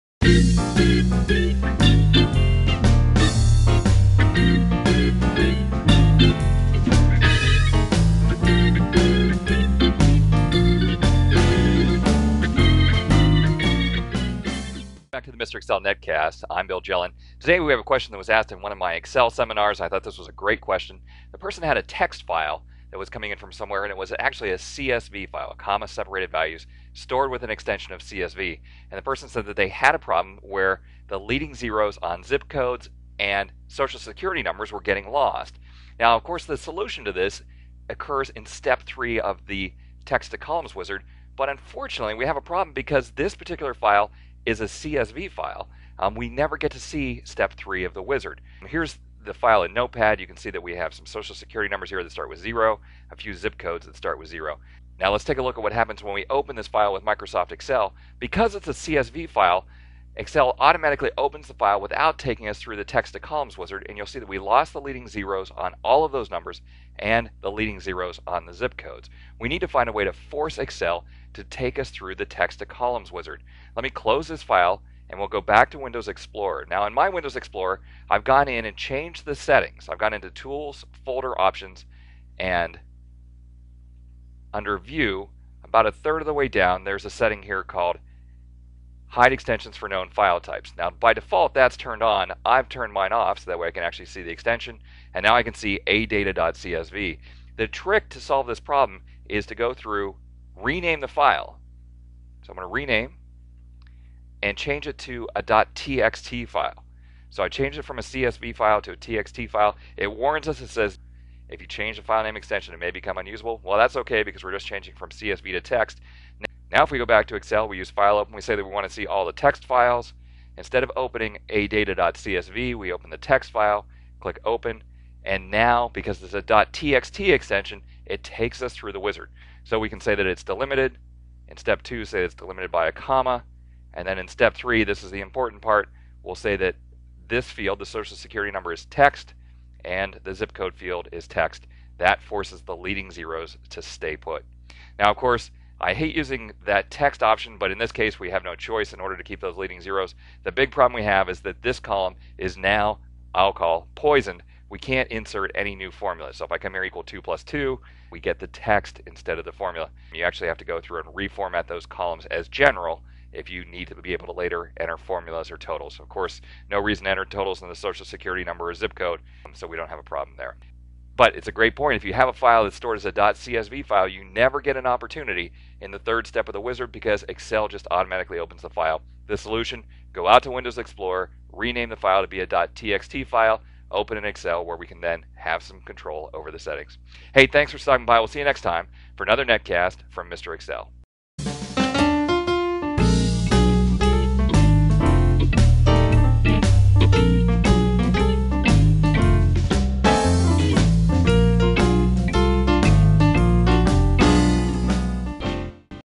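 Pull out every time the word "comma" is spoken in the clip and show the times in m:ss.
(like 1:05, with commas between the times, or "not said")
0:25, 2:12.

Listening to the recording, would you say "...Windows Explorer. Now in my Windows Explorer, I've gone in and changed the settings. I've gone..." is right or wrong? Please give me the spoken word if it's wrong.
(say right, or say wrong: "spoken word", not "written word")
right.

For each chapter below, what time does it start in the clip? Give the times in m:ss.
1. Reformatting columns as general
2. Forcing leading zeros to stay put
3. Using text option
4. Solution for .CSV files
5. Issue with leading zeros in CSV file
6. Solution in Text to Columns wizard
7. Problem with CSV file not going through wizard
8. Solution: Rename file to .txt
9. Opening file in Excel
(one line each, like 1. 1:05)
1. 2:34
2. 2:09
3. 2:24
4. 2:50
5. 0:22
6. 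0:35
7. 0:45
8. 1:09
9. 1:53.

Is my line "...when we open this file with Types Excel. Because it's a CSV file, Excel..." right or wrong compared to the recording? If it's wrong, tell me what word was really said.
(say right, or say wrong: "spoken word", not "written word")
wrong: "Microsoft", not "Types".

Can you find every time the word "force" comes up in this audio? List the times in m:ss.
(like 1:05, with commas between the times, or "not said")
1:10, 2:22.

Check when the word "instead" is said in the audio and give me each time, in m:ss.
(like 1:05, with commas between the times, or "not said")
2:00, 2:39.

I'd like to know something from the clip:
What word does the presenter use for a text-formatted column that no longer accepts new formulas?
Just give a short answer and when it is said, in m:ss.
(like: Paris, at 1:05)
poisoned, at 2:33.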